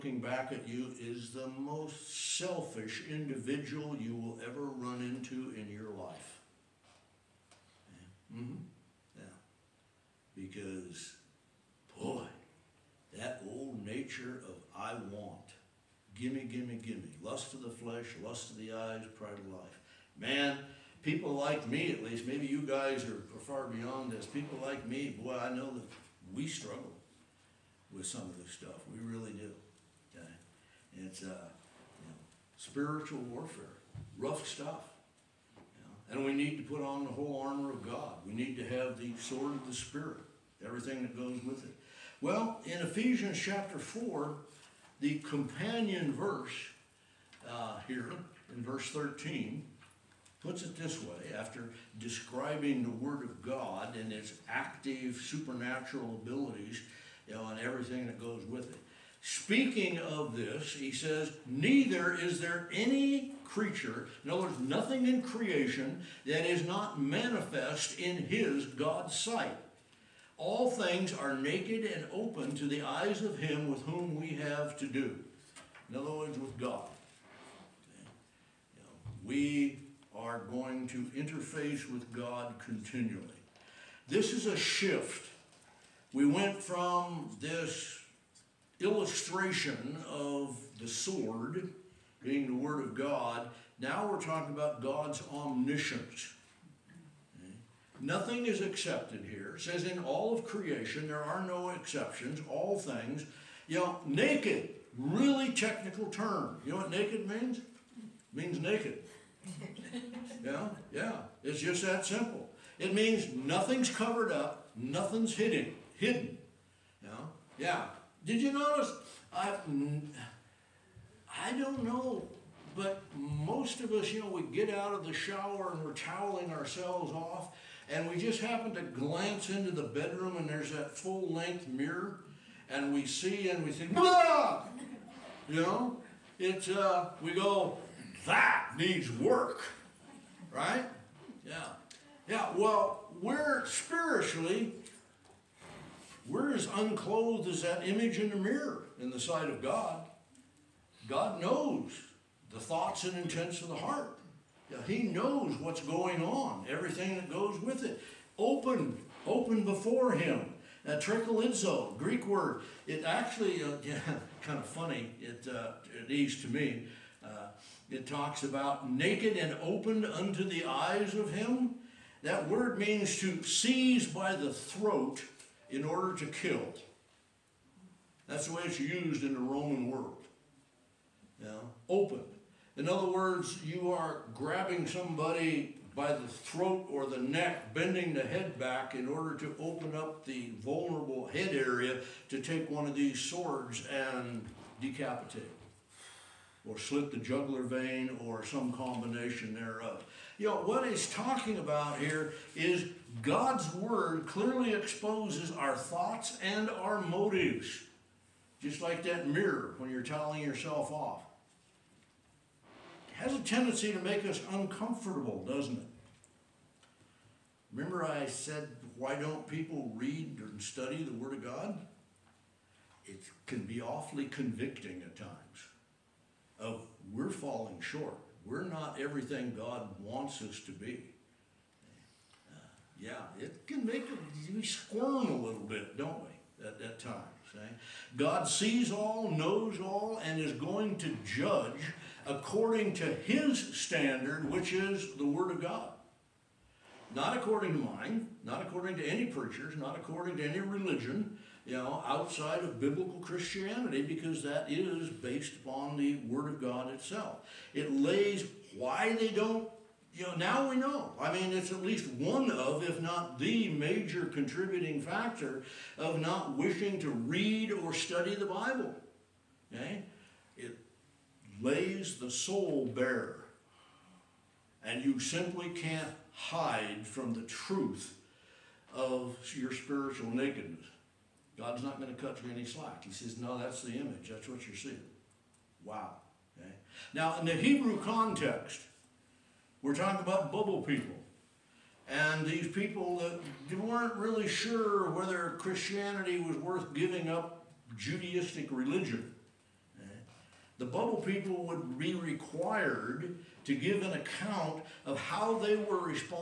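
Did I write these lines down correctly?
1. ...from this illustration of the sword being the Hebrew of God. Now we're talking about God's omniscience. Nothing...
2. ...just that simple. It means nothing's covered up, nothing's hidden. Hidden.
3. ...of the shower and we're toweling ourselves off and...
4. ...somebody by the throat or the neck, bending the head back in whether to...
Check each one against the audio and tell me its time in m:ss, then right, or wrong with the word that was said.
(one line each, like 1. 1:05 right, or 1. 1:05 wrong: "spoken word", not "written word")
1. 1:26 wrong: "Word", not "Hebrew"
2. 1:51 right
3. 2:04 right
4. 3:04 wrong: "order", not "whether".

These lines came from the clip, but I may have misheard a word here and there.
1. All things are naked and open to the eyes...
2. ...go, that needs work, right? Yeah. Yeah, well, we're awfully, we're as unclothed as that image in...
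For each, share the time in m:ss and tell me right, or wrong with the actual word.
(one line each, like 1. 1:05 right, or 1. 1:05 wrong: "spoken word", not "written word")
1. 1:10 right
2. 2:17 wrong: "spiritually", not "awfully".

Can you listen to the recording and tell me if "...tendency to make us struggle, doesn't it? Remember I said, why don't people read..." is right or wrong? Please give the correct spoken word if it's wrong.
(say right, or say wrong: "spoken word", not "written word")
wrong: "uncomfortable", not "struggle".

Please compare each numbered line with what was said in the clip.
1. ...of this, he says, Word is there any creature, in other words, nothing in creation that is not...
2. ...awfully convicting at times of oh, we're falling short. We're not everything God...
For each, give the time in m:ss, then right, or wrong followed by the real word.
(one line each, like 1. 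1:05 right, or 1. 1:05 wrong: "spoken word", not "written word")
1. 0:59 wrong: "Neither", not "Word"
2. 3:43 right.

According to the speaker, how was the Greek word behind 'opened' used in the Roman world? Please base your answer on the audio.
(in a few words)
To seize by the throat.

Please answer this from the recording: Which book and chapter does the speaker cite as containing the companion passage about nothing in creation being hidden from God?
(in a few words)
Ephesians chapter 4.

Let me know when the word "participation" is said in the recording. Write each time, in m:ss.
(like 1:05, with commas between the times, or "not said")
not said.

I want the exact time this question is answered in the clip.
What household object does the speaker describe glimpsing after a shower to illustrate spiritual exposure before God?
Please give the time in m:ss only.
2:10.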